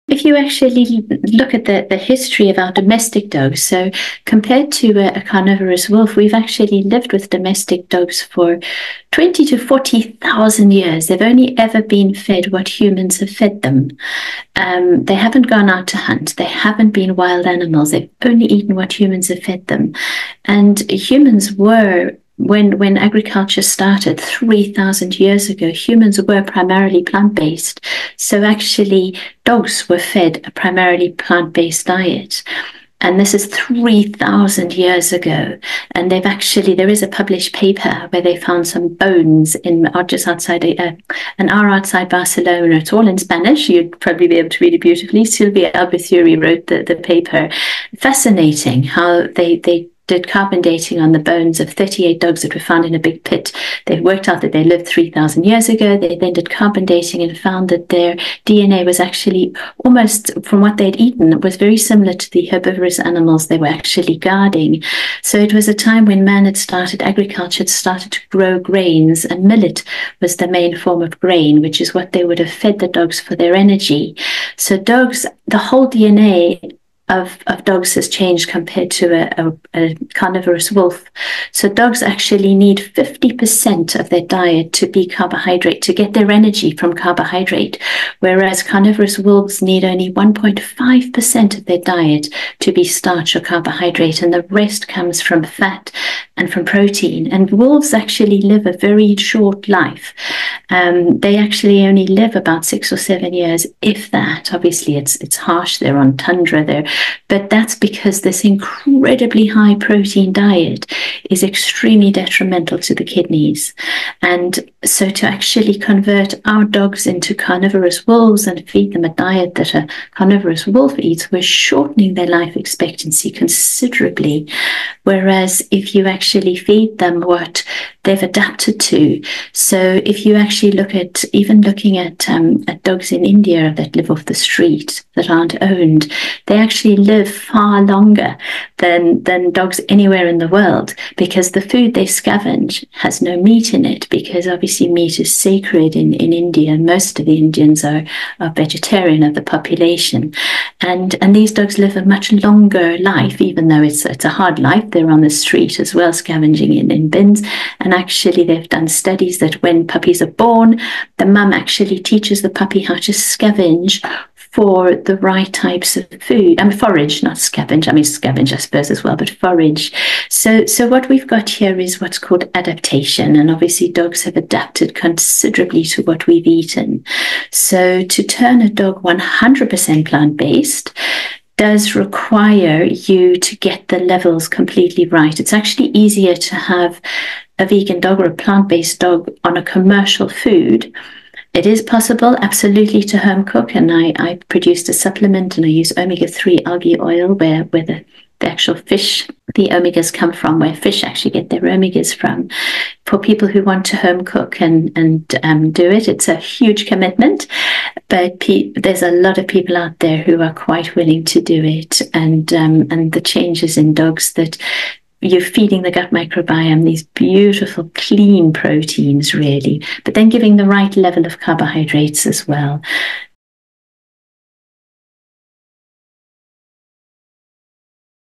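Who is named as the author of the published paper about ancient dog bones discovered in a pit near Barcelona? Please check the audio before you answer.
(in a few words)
Silvia Albizuri.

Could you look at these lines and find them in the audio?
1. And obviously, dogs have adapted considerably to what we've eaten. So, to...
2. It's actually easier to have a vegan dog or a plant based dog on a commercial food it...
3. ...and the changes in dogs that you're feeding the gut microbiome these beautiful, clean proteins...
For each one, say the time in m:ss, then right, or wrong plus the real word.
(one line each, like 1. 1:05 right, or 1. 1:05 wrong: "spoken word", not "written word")
1. 2:53 right
2. 3:05 right
3. 3:32 right.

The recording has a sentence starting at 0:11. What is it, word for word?
They've only ever been fed what humans have fed them.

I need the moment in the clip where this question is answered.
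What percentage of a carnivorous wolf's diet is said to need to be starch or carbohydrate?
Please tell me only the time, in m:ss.
1:30.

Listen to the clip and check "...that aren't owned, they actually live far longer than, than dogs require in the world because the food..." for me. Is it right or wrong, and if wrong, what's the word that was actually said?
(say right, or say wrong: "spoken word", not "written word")
wrong: "anywhere", not "require".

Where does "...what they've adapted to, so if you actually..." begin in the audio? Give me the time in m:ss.
2:07.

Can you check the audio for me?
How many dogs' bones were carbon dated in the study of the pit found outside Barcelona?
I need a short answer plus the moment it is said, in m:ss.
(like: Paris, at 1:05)
38, at 0:51.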